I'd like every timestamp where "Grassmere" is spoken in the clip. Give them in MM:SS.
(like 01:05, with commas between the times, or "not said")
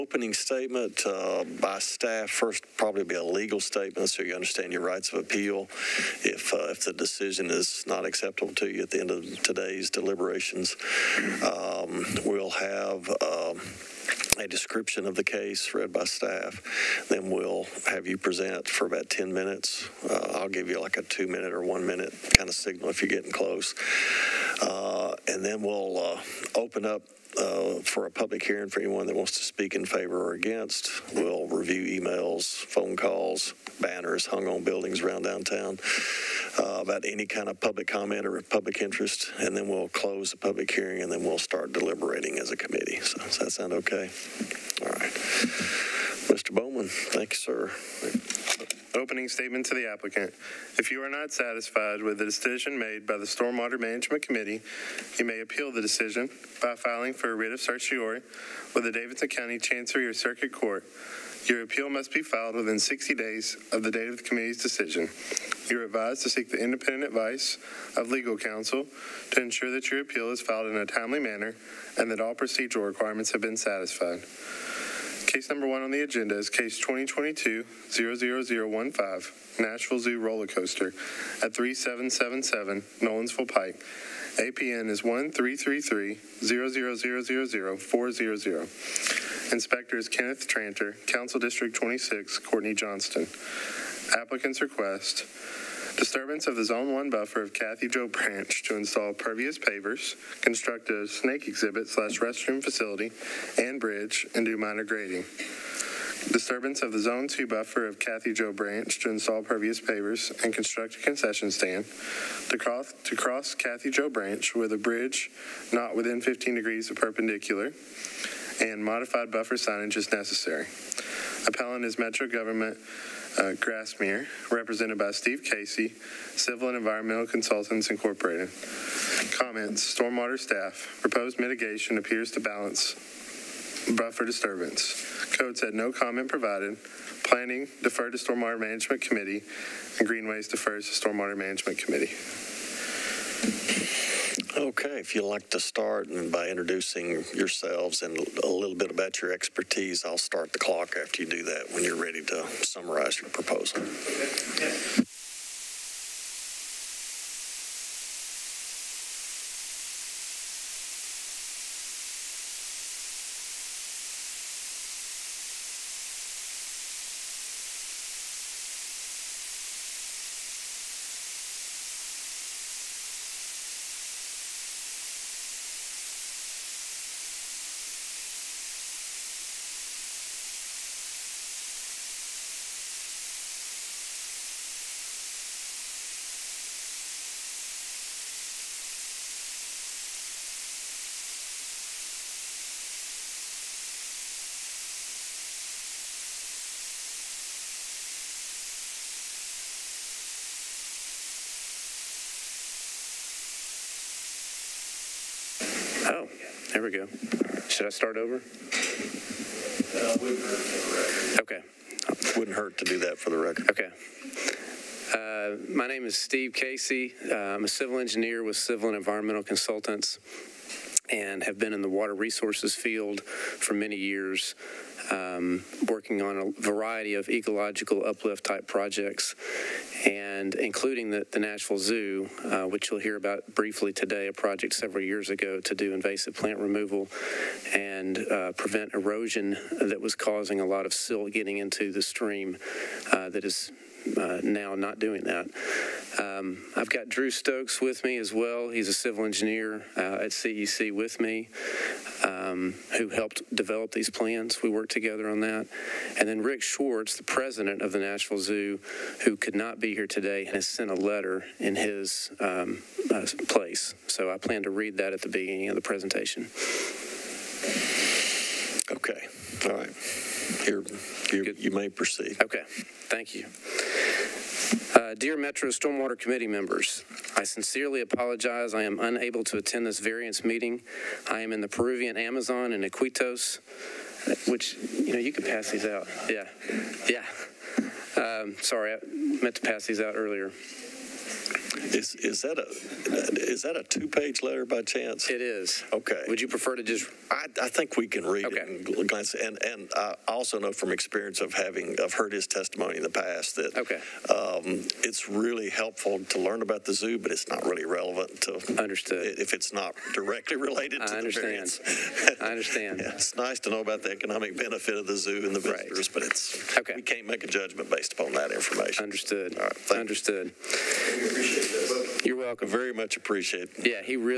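02:03.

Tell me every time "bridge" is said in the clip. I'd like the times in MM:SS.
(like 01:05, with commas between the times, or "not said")
01:43, 01:54.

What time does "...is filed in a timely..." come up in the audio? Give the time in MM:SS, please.
01:10.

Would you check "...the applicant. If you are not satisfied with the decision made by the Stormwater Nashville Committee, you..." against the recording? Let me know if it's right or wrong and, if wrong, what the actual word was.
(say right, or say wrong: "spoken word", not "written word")
wrong: "Management", not "Nashville".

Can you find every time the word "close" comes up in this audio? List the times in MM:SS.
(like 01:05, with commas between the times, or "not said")
00:23, 00:39.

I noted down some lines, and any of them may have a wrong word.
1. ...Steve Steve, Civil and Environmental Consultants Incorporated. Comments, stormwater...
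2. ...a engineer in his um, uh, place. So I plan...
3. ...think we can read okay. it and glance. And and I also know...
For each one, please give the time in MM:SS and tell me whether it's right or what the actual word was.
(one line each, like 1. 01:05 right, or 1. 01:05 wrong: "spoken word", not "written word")
1. 02:05 wrong: "Casey", not "Steve"
2. 04:20 wrong: "letter", not "engineer"
3. 04:57 right.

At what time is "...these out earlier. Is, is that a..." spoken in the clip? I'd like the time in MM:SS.
04:49.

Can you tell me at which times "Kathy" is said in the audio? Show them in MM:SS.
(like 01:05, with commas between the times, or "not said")
01:37, 01:47, 01:53.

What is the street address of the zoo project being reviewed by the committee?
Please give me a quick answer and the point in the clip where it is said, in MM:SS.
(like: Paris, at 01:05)
3777 Nolensville Pike, at 01:21.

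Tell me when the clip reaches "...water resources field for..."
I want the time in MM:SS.
03:41.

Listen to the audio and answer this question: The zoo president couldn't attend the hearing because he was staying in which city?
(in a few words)
Iquitos.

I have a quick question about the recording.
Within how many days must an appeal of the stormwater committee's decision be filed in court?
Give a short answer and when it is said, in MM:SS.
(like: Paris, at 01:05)
60, at 01:02.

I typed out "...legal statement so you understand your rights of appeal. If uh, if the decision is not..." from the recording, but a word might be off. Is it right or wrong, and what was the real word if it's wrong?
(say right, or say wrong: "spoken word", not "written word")
right.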